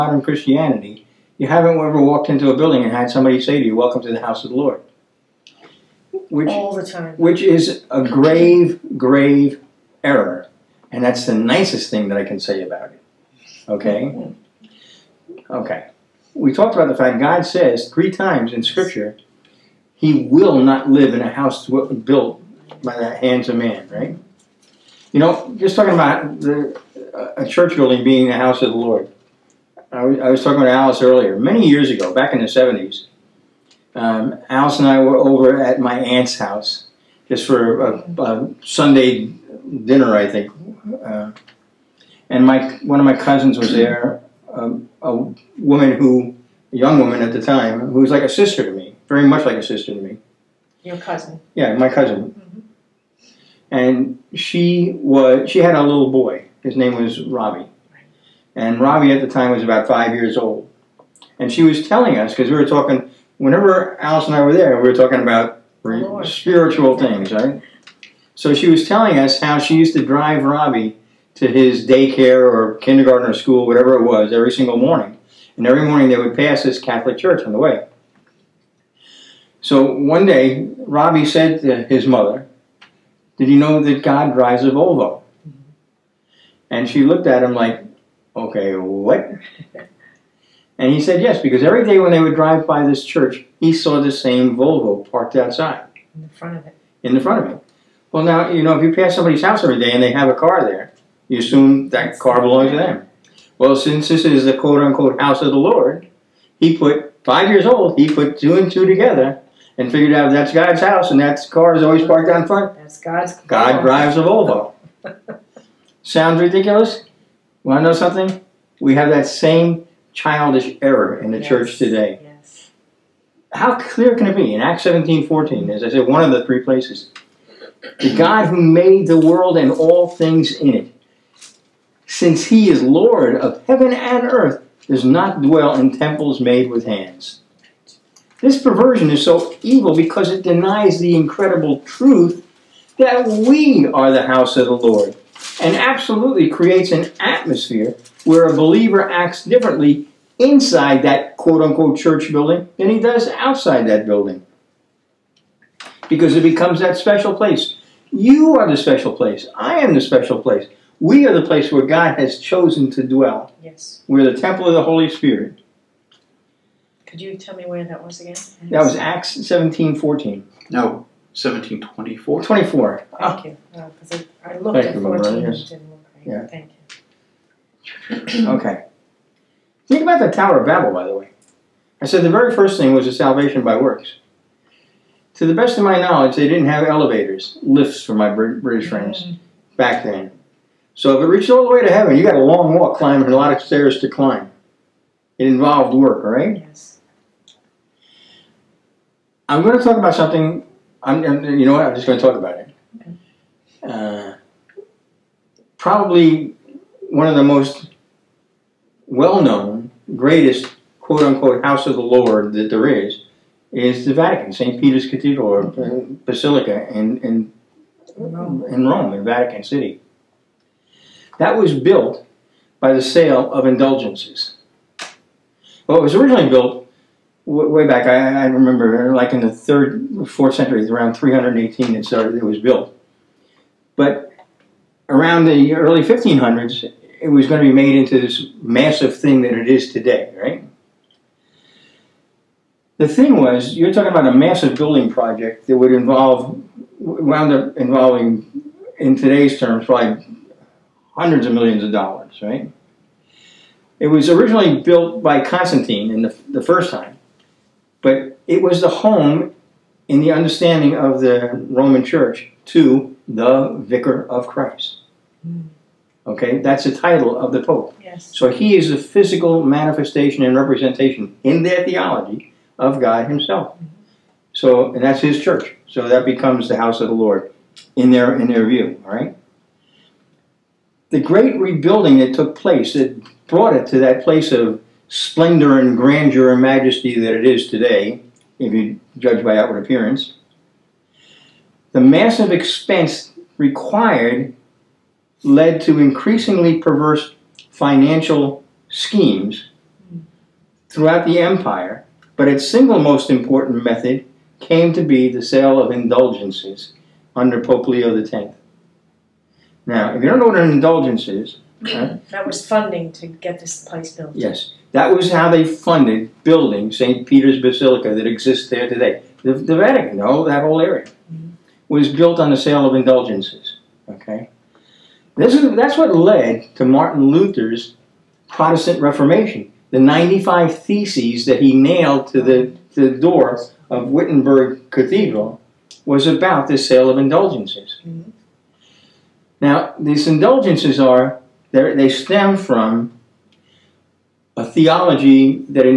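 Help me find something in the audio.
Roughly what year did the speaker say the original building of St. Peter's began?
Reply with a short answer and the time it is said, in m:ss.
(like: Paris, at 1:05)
318, at 3:51.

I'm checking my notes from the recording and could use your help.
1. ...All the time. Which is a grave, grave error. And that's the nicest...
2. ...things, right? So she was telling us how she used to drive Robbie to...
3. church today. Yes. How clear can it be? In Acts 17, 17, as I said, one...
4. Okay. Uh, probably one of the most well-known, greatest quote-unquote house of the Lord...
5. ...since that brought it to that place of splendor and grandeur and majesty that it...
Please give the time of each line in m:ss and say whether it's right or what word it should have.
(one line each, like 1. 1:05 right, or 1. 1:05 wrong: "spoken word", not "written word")
1. 0:06 right
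2. 1:06 right
3. 2:01 wrong: "14", not "17"
4. 3:22 right
5. 4:42 wrong: "place", not "since".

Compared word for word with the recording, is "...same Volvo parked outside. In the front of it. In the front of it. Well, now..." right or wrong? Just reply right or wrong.
right.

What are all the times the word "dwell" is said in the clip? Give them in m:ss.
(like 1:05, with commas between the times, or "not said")
2:15, 2:43.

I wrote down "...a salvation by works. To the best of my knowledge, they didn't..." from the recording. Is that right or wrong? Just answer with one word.
right.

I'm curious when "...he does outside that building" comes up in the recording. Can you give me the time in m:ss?
2:32.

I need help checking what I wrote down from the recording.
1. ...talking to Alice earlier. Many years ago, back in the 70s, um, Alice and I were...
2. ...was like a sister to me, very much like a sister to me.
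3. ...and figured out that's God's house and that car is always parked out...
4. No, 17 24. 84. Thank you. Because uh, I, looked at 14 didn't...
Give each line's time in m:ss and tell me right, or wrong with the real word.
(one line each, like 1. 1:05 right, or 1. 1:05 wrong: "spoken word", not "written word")
1. 0:30 right
2. 0:48 right
3. 1:49 right
4. 2:50 wrong: "24", not "84".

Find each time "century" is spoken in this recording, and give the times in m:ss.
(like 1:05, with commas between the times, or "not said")
3:50.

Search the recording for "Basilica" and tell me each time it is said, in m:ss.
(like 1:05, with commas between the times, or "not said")
3:36, 5:17.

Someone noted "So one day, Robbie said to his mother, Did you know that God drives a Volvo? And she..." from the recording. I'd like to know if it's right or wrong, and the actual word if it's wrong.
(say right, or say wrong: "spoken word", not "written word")
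right.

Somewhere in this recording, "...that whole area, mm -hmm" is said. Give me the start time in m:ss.
5:20.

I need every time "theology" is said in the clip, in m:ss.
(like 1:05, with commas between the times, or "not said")
4:31, 5:44.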